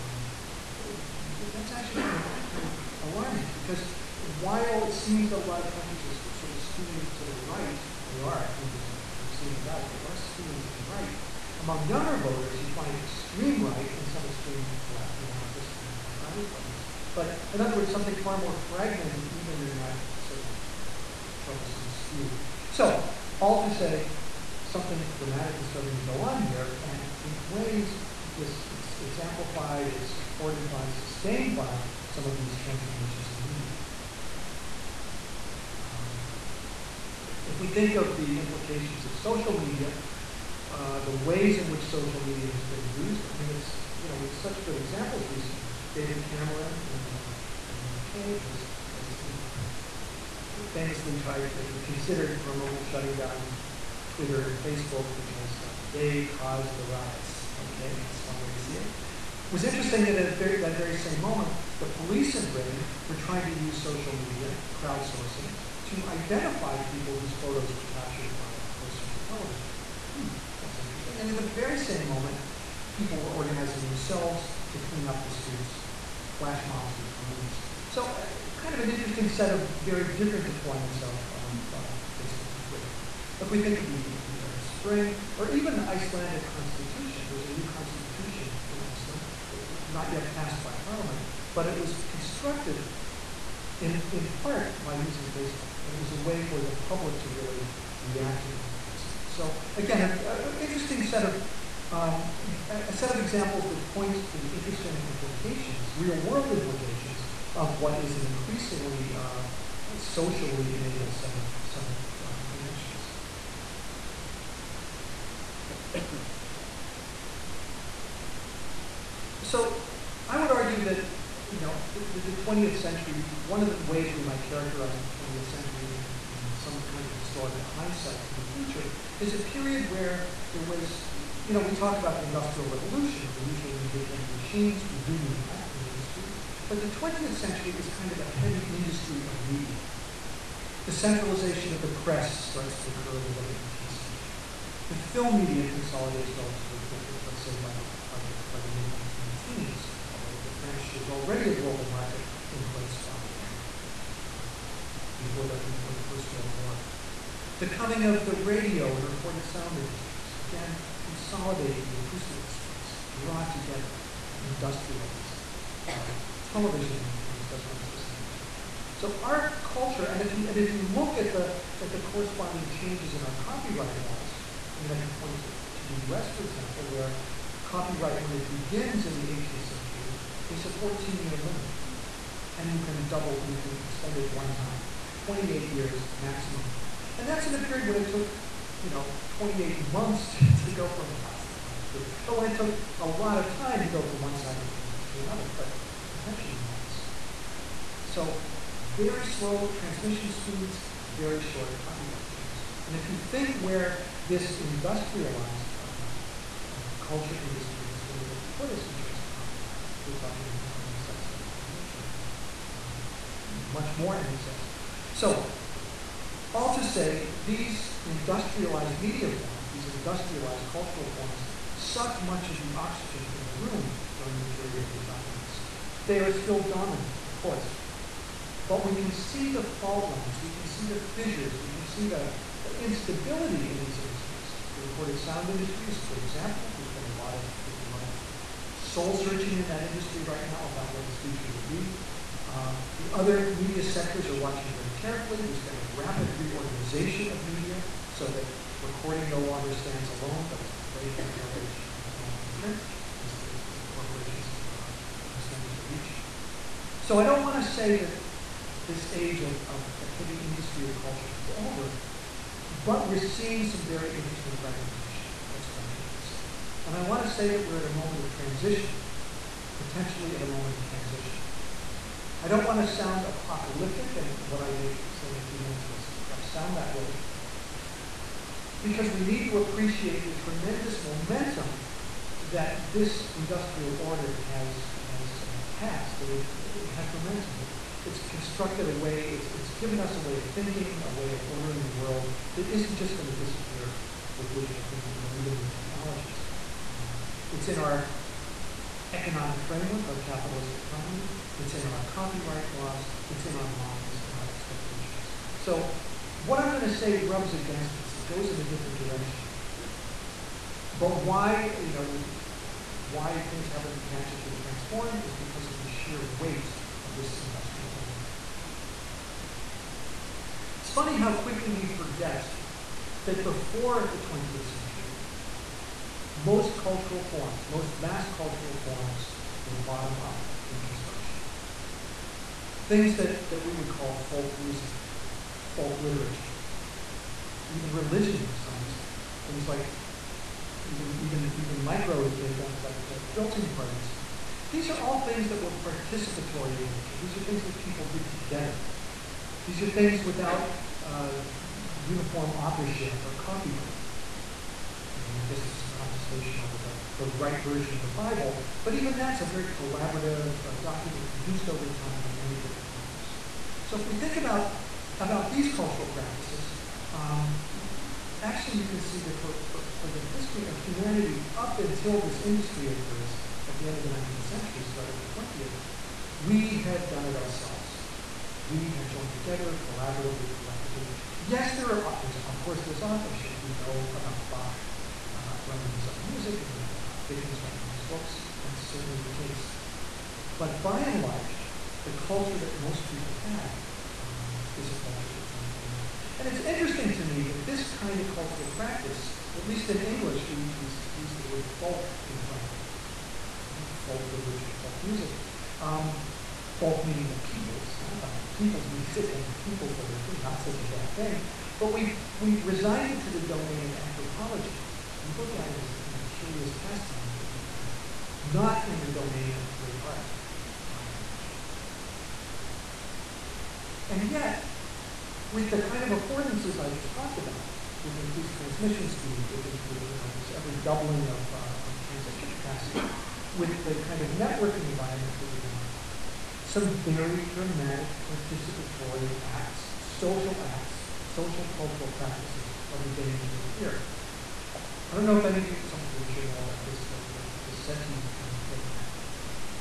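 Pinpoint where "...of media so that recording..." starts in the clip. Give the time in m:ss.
4:07.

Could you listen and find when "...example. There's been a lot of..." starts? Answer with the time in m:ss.
3:56.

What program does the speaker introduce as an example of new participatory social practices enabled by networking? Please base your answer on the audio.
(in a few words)
SETI.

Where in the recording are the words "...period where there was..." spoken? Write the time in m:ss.
2:09.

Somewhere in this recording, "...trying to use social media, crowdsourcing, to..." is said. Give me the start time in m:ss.
1:03.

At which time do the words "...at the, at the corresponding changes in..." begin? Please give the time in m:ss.
2:51.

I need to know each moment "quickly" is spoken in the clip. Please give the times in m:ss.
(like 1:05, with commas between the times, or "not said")
2:26, 5:21.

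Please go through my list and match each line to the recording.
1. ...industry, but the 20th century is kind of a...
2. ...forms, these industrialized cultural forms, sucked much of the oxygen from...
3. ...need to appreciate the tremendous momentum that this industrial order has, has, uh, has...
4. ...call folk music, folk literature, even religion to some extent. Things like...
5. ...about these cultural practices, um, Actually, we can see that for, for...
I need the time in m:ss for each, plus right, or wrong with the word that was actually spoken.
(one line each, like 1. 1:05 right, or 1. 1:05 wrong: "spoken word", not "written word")
1. 2:15 right
2. 3:39 right
3. 4:39 right
4. 5:33 right
5. 6:05 right.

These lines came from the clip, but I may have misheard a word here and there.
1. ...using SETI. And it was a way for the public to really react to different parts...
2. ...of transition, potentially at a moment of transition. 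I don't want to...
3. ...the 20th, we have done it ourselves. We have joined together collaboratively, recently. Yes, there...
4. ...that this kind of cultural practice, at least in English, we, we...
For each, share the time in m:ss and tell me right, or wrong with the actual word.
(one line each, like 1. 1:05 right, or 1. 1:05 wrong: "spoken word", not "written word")
1. 1:35 wrong: "Facebook", not "SETI"
2. 4:28 right
3. 6:15 wrong: "collectively", not "recently"
4. 6:37 right.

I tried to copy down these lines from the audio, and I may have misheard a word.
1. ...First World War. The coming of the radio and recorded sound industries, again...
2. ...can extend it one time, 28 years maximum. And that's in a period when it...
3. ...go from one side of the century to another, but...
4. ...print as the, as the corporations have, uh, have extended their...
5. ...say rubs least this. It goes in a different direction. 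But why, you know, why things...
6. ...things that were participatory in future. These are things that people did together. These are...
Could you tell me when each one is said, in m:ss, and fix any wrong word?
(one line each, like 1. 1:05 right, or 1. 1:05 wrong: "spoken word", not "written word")
1. 2:36 right
2. 3:03 right
3. 3:13 wrong: "country", not "century"
4. 4:12 right
5. 5:06 wrong: "against", not "least"
6. 5:45 wrong: "nature", not "future".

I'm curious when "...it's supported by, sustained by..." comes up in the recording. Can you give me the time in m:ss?
0:29.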